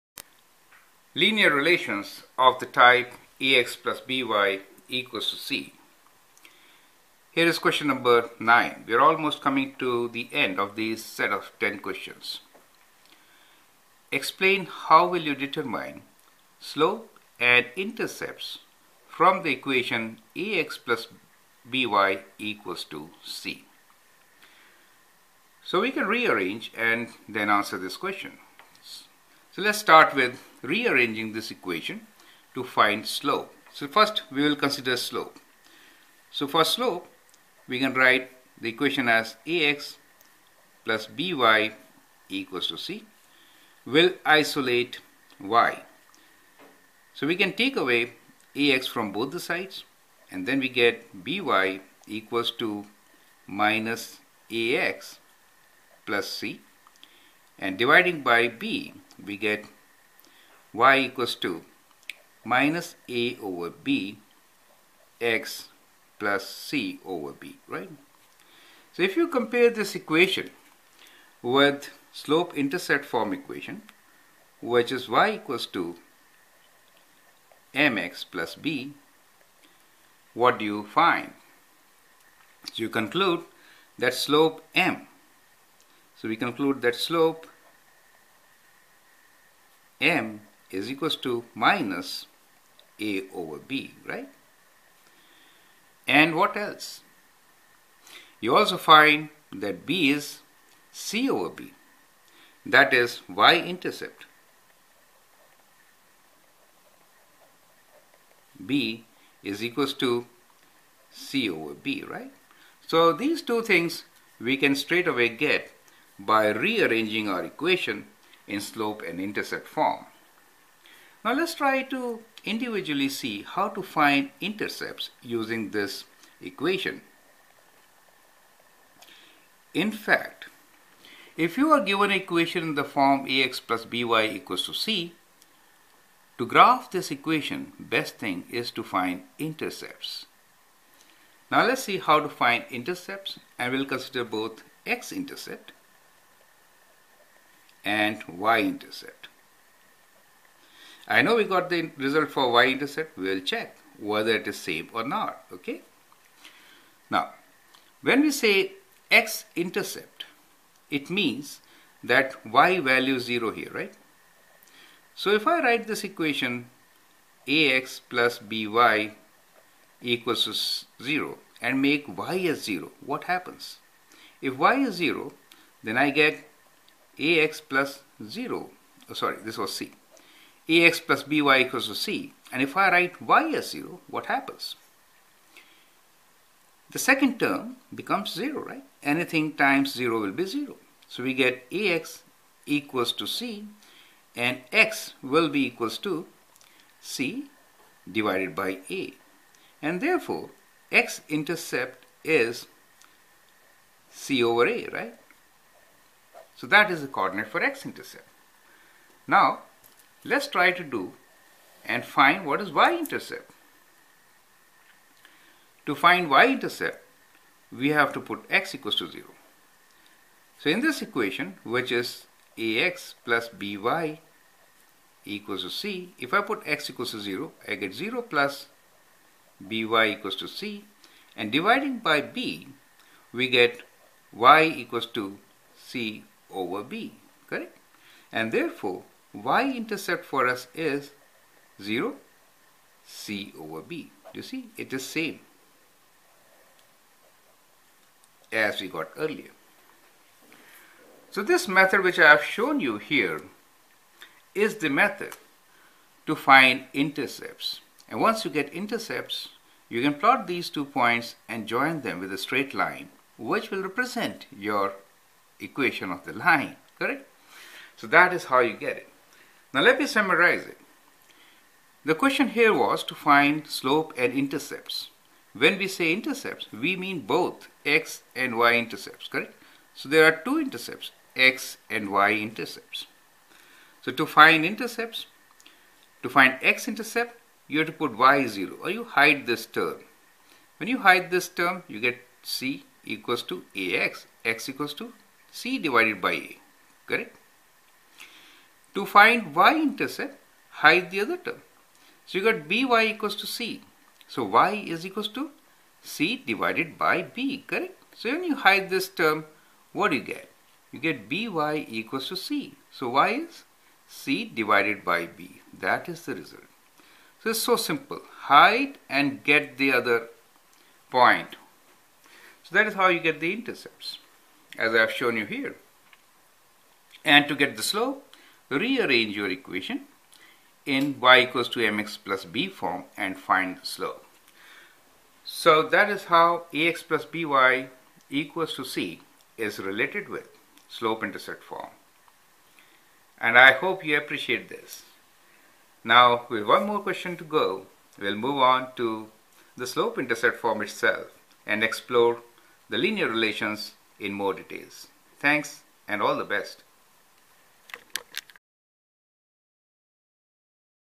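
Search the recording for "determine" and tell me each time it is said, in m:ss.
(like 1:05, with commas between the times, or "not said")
0:15.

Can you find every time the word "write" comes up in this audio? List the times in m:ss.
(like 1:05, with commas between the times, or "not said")
0:37, 2:45, 3:02.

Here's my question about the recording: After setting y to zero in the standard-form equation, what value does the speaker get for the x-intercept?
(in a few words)
c over a.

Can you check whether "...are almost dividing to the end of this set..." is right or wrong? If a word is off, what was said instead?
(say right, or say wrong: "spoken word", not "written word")
wrong: "coming", not "dividing".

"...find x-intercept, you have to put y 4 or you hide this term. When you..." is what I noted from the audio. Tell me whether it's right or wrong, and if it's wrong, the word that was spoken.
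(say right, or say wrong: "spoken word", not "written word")
wrong: "0", not "4".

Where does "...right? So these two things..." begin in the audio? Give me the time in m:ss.
1:52.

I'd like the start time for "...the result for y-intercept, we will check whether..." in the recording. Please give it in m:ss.
2:31.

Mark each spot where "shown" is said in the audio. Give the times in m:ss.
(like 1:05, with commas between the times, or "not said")
4:12, 5:25.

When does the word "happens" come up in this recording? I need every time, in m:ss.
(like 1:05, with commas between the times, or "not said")
2:53, 3:04.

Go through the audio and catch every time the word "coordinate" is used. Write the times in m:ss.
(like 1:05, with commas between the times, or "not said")
3:27.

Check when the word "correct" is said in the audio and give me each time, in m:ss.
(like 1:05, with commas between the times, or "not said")
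3:57, 4:26, 4:39, 4:57, 5:07.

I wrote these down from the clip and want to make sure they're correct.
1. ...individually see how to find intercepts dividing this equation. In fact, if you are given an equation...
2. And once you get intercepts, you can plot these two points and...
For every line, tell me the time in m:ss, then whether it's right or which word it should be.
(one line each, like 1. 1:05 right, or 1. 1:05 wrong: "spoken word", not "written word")
1. 2:02 wrong: "using", not "dividing"
2. 4:18 right.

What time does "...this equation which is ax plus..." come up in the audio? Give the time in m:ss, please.
3:40.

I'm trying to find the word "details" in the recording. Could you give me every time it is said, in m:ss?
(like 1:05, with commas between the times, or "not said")
5:54.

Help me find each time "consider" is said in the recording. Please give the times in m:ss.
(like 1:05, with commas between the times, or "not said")
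0:34, 2:23.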